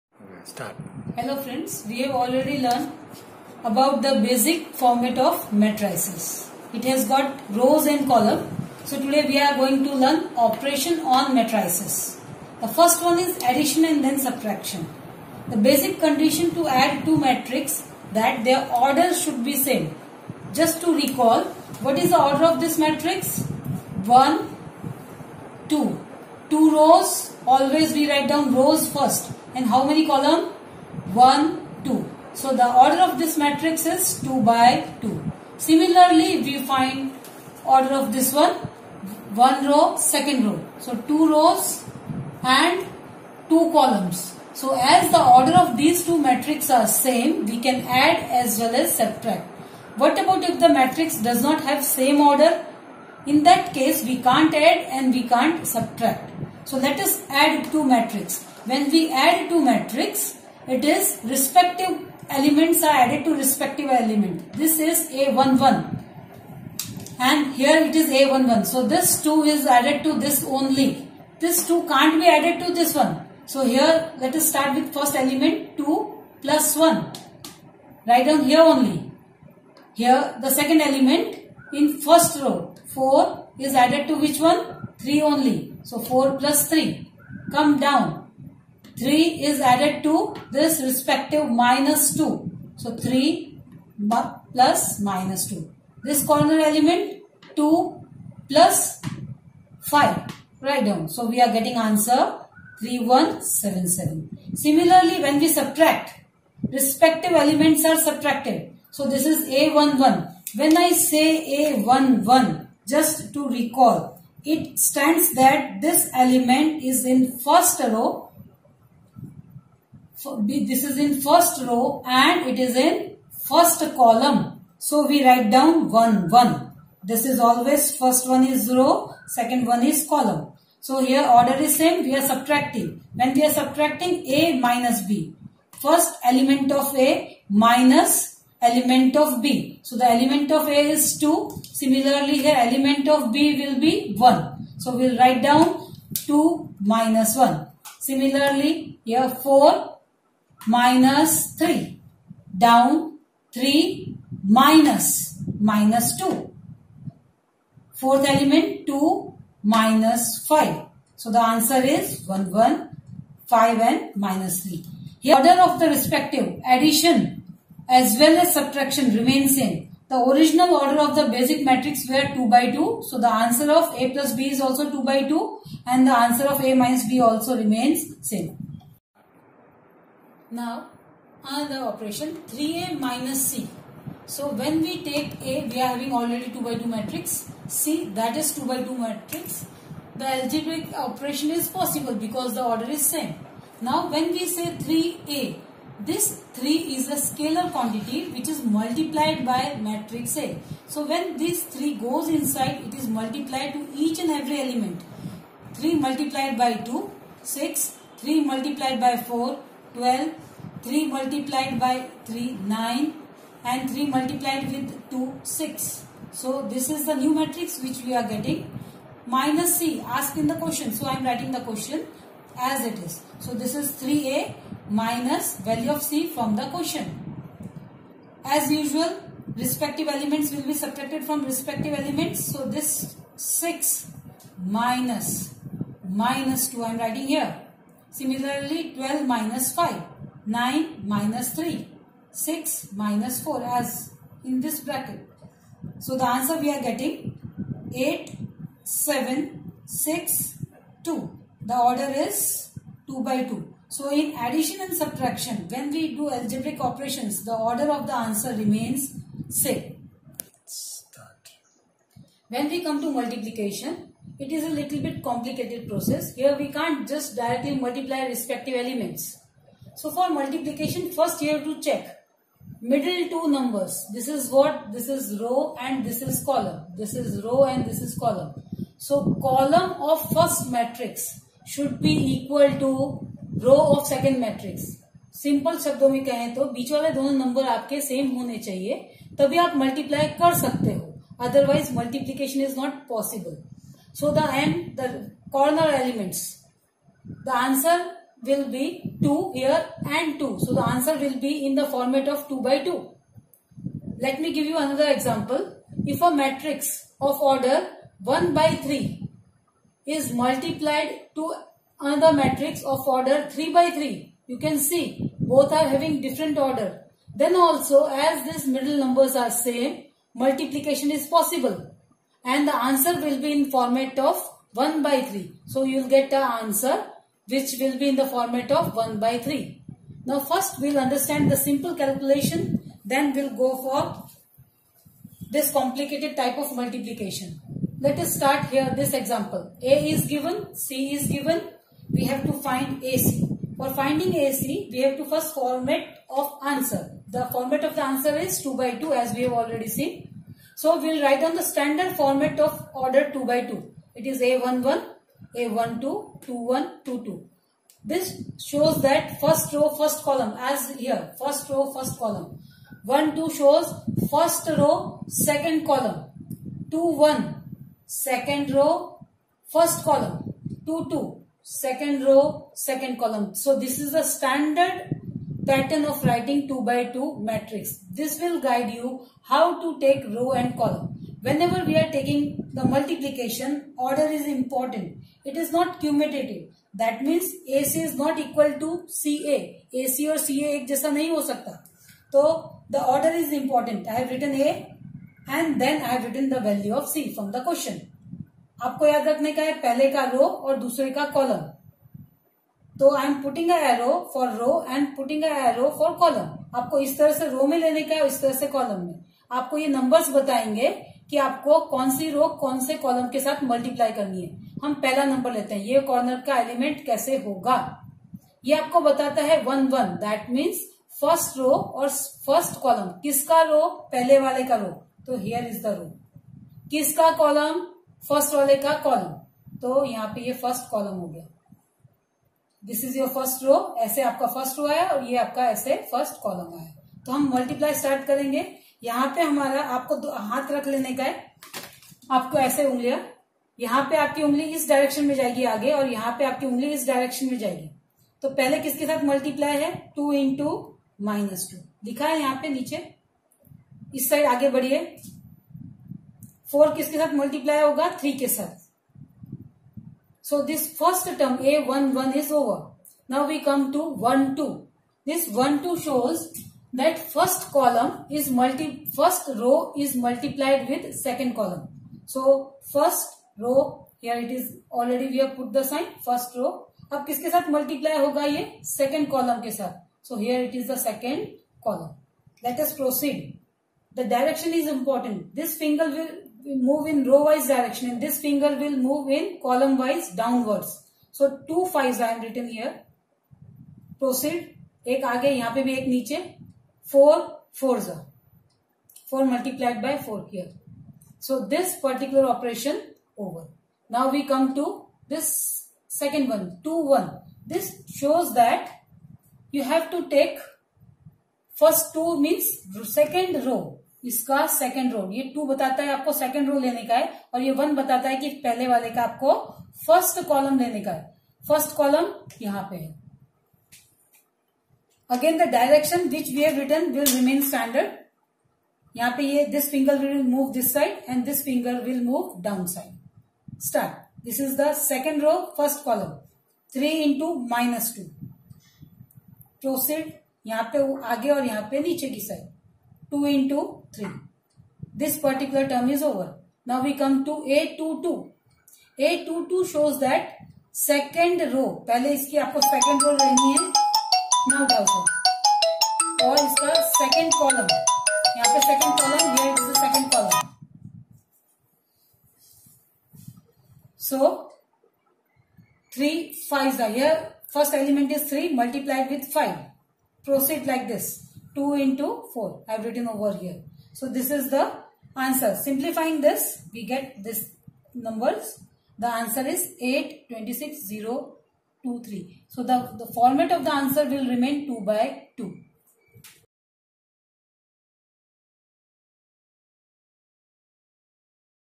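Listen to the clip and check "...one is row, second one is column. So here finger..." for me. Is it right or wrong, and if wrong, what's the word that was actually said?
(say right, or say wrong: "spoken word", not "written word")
wrong: "order", not "finger".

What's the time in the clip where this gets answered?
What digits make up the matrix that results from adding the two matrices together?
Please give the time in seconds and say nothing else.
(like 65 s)
102 s.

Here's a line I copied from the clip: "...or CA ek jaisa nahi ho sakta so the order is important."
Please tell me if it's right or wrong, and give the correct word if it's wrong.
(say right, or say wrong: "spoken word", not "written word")
right.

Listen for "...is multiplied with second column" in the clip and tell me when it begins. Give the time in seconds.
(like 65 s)
469 s.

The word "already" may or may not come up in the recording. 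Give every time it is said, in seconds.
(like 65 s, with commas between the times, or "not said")
2 s, 186 s, 349 s, 474 s.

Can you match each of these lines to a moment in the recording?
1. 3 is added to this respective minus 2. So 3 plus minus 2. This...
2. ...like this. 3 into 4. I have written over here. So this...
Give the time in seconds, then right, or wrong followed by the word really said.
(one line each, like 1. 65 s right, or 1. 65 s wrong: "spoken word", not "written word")
1. 89 s right
2. 570 s wrong: "2", not "3".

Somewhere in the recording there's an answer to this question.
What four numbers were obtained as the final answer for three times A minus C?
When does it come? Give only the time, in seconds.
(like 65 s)
247 s.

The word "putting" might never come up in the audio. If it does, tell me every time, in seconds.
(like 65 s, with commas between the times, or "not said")
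not said.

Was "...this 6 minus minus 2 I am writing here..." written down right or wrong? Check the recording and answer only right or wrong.
right.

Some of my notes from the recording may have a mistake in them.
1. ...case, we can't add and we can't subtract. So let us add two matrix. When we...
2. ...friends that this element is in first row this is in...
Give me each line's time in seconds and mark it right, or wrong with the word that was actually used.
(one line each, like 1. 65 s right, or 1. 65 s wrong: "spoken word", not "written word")
1. 53 s right
2. 114 s wrong: "stands", not "friends".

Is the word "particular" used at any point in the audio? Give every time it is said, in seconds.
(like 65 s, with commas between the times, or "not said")
501 s, 545 s.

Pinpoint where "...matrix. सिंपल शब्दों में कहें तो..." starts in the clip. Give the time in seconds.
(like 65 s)
284 s.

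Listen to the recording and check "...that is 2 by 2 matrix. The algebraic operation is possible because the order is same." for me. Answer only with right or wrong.
right.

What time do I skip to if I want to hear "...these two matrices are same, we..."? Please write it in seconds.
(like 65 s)
45 s.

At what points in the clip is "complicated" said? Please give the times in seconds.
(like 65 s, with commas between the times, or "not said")
265 s, 335 s.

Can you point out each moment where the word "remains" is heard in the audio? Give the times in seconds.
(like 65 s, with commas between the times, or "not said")
169 s, 177 s, 258 s, 584 s.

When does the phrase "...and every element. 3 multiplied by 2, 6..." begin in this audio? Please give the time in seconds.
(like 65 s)
204 s.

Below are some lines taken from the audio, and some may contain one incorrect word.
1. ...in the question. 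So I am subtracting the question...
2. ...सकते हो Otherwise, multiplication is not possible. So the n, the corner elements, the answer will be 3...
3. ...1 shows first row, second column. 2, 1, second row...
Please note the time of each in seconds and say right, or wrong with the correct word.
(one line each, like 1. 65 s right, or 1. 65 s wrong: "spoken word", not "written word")
1. 220 s wrong: "writing", not "subtracting"
2. 290 s wrong: "2", not "3"
3. 363 s wrong: "2", not "1".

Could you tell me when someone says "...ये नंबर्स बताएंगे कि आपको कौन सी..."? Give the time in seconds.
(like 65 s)
409 s.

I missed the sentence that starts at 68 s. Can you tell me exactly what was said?
So this 2 is added to this only.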